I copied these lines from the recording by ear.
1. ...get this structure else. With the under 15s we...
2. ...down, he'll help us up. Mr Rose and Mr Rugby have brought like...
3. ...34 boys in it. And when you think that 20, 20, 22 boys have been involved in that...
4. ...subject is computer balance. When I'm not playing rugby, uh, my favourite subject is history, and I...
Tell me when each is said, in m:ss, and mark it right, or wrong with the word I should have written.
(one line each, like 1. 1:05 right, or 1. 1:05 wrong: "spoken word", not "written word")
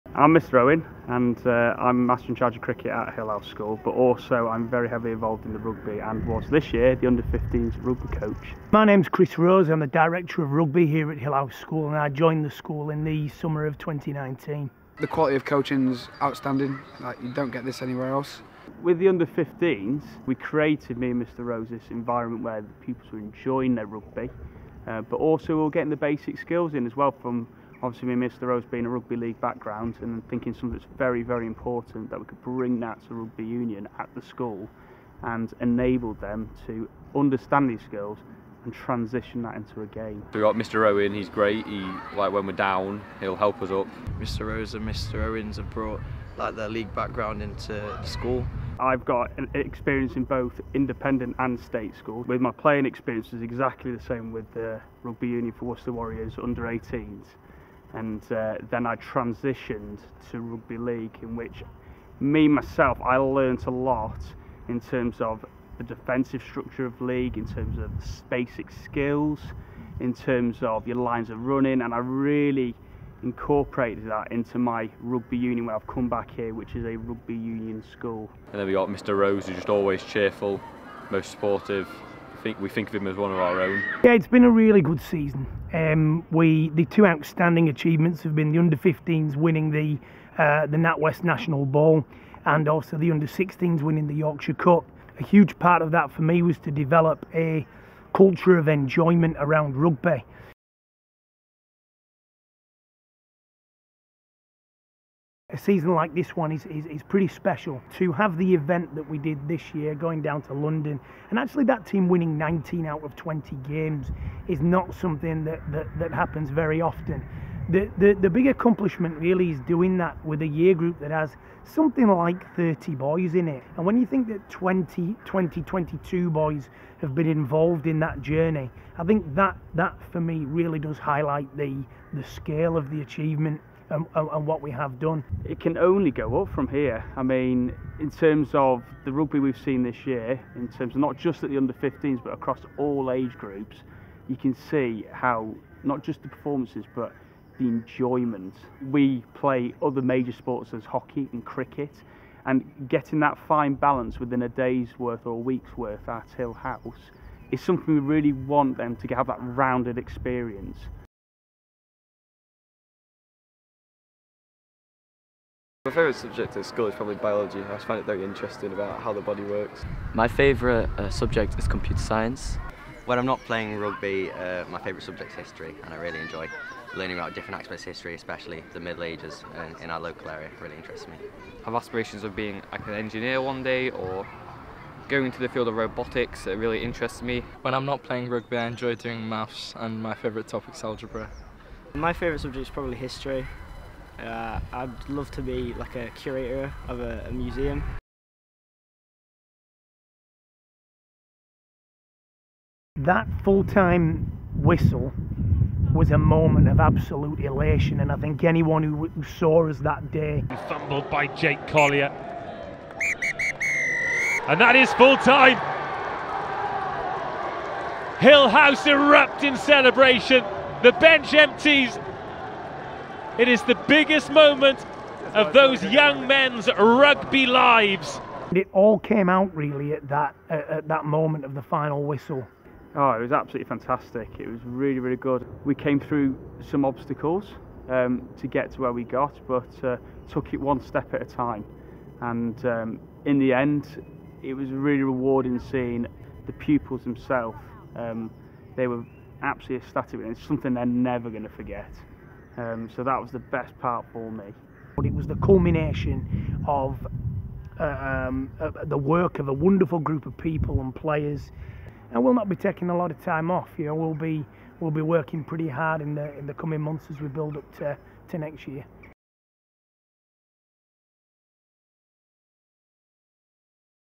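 1. 0:17 wrong: "anywhere", not "structure"
2. 0:42 wrong: "Owens", not "Rugby"
3. 2:02 wrong: "30", not "34"
4. 2:51 wrong: "science", not "balance".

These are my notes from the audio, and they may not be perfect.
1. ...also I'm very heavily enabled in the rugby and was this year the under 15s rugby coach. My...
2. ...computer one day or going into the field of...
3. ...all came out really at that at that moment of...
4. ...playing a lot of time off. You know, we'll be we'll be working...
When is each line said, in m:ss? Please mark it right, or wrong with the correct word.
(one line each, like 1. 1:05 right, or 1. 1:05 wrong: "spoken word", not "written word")
1. 0:03 wrong: "involved", not "enabled"
2. 3:02 wrong: "engineer", not "computer"
3. 3:48 right
4. 4:22 wrong: "taking", not "playing".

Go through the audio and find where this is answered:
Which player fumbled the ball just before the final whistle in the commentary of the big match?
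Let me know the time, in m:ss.
3:31.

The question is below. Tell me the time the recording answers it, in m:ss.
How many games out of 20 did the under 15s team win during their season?
1:52.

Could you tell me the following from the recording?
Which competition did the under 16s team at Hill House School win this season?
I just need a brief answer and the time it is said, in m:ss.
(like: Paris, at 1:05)
Yorkshire Cup, at 1:34.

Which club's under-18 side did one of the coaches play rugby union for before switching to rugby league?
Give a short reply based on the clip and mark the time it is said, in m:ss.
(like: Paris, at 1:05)
Worcester Warriors, at 0:55.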